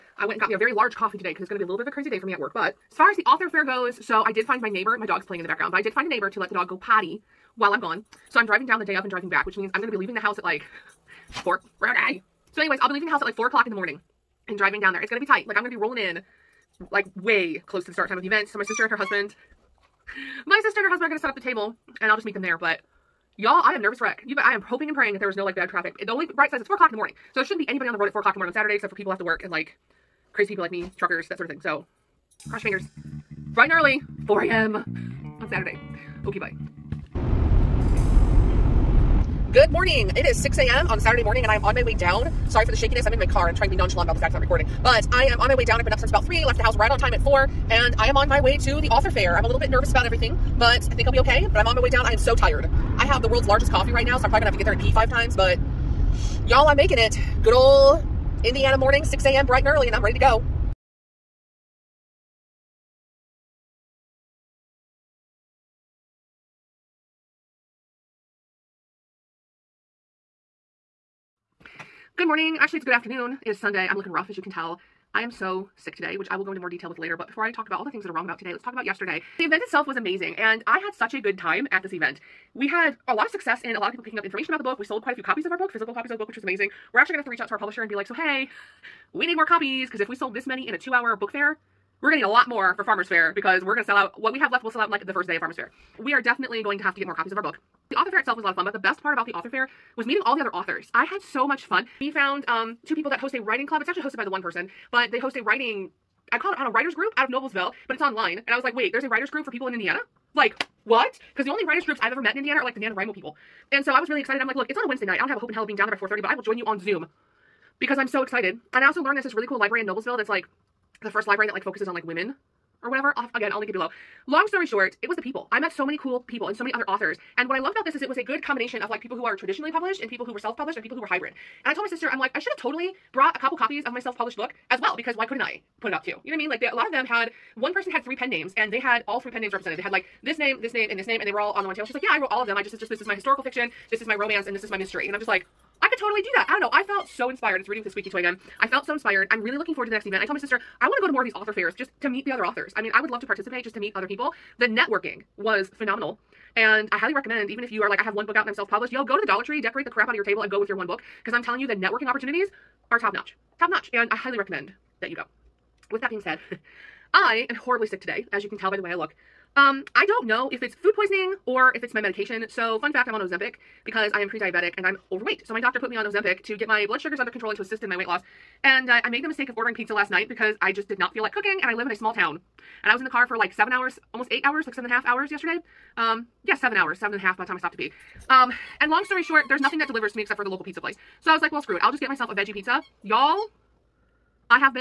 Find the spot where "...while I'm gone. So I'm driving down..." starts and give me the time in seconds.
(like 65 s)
7 s.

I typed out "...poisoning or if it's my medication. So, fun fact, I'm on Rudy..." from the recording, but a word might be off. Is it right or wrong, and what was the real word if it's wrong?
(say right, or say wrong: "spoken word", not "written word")
wrong: "Ozempic", not "Rudy".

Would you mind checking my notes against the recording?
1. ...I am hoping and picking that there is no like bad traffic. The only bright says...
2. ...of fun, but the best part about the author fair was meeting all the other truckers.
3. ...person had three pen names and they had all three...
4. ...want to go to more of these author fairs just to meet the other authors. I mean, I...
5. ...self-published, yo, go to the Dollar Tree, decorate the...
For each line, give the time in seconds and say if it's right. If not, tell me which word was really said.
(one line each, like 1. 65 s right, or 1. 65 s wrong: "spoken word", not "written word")
1. 24 s wrong: "praying", not "picking"
2. 98 s wrong: "authors", not "truckers"
3. 137 s right
4. 150 s right
5. 158 s right.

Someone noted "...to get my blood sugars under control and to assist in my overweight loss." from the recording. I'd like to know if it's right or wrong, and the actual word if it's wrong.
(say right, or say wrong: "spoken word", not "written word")
wrong: "weight", not "overweight".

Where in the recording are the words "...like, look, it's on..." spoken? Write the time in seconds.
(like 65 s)
114 s.